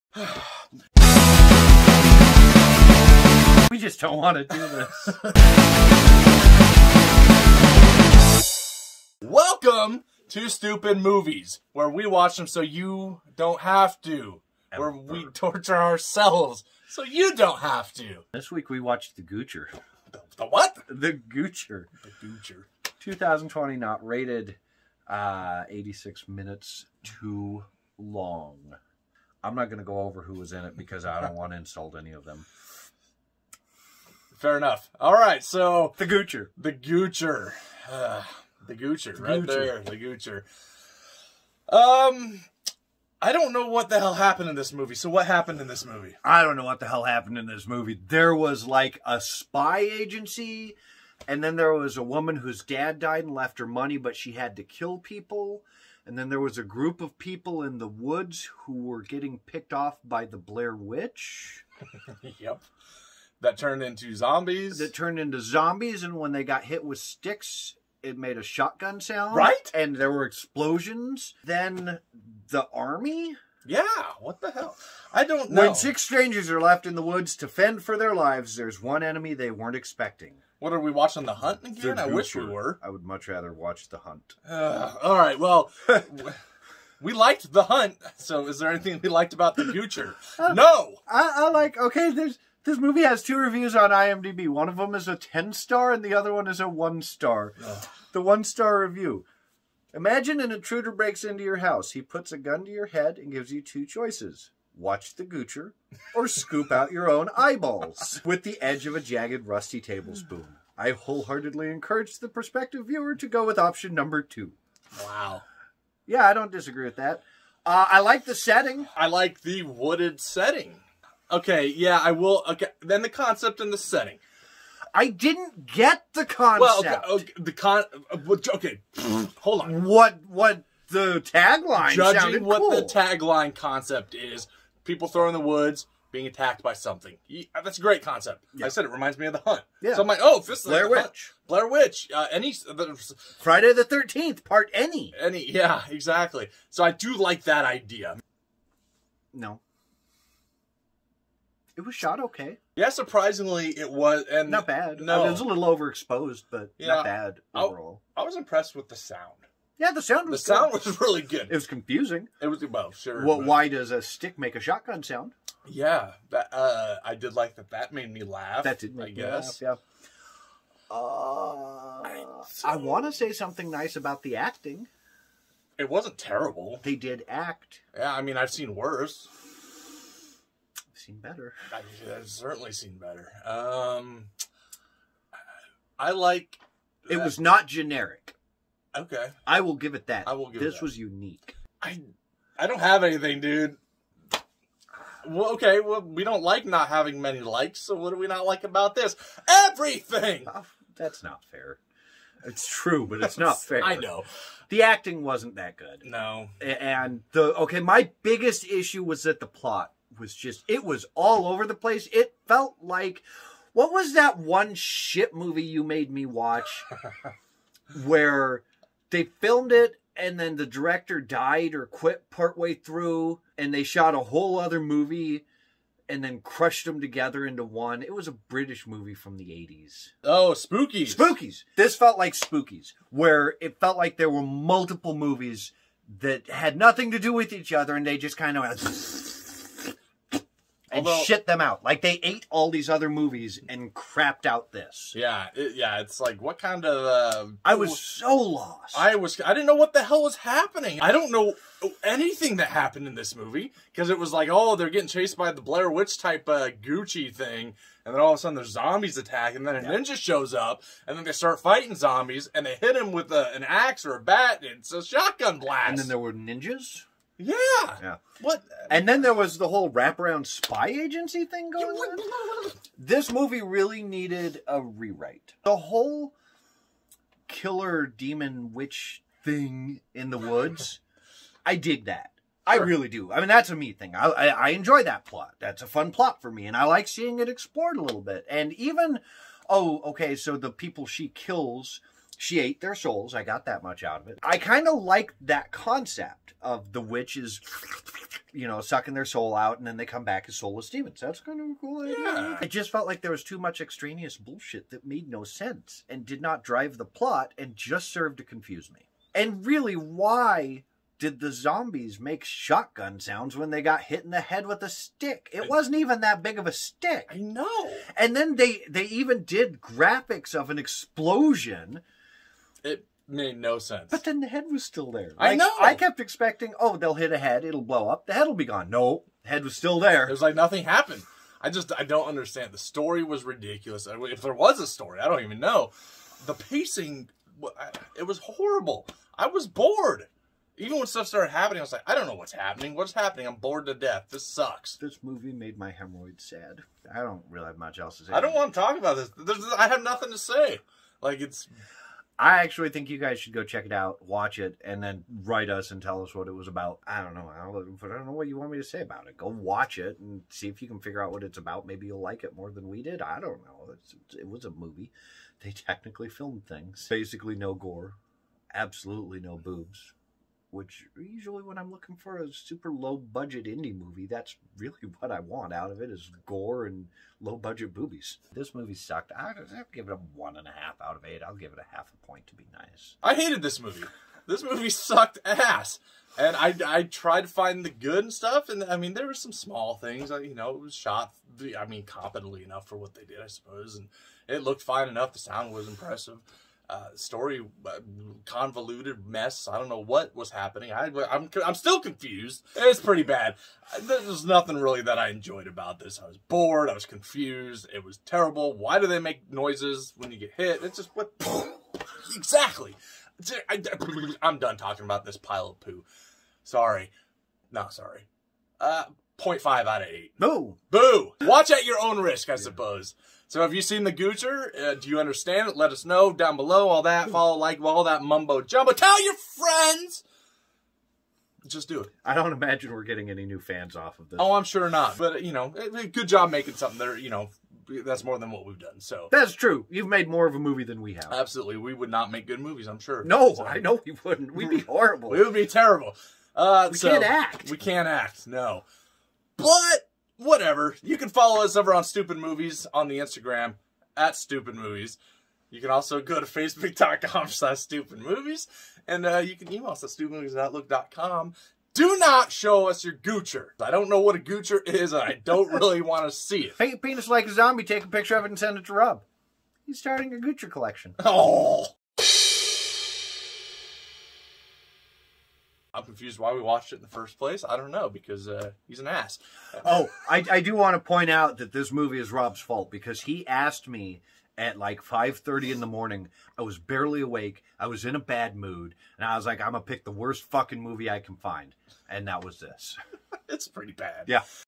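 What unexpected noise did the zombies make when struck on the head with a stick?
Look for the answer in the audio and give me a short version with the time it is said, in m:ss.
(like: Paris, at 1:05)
a shotgun blast, at 4:25.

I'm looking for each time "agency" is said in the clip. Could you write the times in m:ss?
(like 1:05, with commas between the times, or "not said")
0:49, 4:30.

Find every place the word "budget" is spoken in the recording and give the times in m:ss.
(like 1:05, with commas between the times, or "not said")
6:13, 6:17.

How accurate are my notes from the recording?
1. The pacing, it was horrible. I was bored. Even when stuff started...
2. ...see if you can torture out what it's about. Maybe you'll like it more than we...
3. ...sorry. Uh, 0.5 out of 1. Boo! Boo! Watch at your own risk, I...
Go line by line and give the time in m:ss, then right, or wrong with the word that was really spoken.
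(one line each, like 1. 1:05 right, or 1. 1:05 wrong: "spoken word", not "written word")
1. 5:36 right
2. 6:00 wrong: "figure", not "torture"
3. 6:57 wrong: "8", not "1".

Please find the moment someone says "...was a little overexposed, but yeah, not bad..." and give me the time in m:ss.
2:35.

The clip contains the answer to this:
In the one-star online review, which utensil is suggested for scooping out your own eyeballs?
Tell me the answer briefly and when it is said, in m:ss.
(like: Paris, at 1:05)
tablespoon, at 1:49.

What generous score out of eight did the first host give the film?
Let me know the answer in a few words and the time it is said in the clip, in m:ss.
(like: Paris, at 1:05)
1.5, at 6:20.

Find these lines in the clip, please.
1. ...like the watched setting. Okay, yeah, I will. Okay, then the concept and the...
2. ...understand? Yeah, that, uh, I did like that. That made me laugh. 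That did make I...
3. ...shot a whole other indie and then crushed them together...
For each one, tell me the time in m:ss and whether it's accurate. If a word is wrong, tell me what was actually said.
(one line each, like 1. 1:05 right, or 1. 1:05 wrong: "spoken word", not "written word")
1. 1:59 wrong: "wooded", not "watched"
2. 2:45 wrong: "sound", not "understand"
3. 3:43 wrong: "movie", not "indie".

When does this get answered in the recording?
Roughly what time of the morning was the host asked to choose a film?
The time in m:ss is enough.
8:05.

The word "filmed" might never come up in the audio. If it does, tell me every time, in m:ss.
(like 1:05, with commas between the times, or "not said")
3:39, 6:06.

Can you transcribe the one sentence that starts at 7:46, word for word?
Paint penis like a zombie, take a picture of it and send it to Rob.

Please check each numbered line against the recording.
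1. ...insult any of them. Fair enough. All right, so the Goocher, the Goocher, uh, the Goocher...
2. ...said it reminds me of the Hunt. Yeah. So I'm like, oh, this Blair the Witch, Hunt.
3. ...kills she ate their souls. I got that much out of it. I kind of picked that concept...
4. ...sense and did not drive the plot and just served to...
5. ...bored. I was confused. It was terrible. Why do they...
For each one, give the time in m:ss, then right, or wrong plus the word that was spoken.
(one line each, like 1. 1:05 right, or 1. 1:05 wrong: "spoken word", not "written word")
1. 0:31 right
2. 2:18 right
3. 4:51 wrong: "liked", not "picked"
4. 5:05 right
5. 6:46 right.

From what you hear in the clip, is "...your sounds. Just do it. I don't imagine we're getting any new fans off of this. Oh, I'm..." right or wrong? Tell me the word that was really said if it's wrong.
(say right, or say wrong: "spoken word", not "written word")
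wrong: "friends", not "sounds".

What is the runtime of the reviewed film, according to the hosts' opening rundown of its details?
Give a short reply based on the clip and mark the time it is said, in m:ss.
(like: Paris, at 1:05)
86 minutes, at 0:25.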